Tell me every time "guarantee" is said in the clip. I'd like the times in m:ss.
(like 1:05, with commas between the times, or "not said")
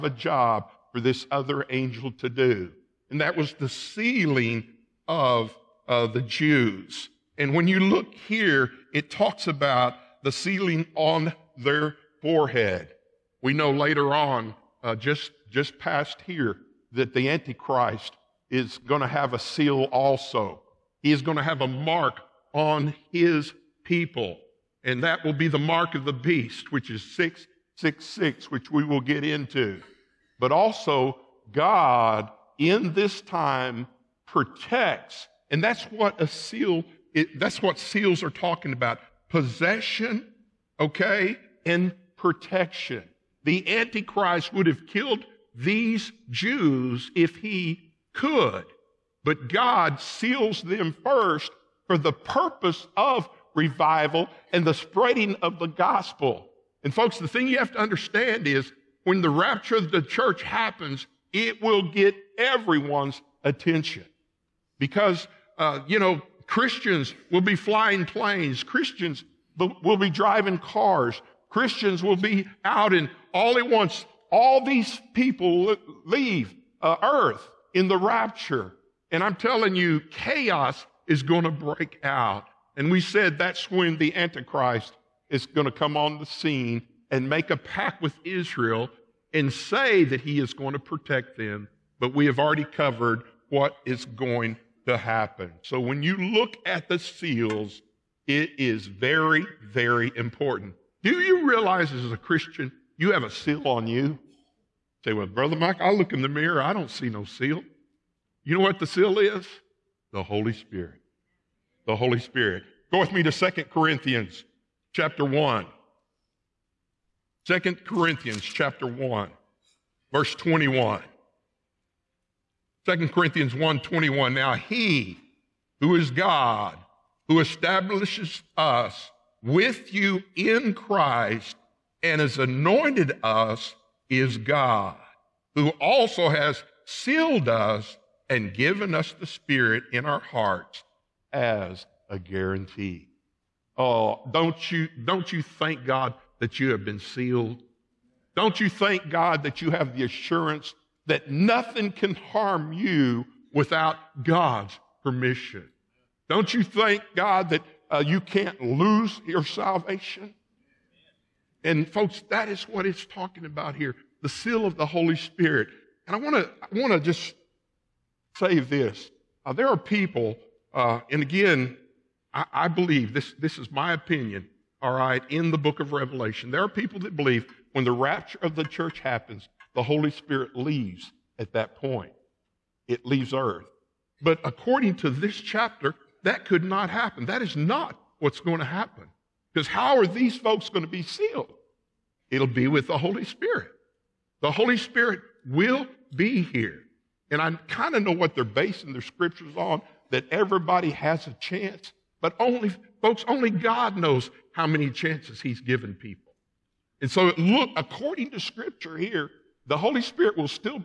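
2:22.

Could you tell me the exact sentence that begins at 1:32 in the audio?
But we have already covered what is going to happen.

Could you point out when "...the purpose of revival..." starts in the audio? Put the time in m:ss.
0:51.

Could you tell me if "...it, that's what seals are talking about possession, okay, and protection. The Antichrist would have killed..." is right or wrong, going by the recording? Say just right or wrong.
right.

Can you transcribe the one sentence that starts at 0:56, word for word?
And folks, the thing you have to understand is when the rapture of the church happens, it will get everyone's attention.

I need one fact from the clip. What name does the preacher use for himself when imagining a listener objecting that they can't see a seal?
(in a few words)
Brother Mike.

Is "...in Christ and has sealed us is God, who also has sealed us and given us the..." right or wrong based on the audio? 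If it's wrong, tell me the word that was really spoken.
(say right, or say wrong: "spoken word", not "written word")
wrong: "anointed", not "sealed".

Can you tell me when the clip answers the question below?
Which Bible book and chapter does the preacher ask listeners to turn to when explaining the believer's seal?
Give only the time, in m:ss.
1:53.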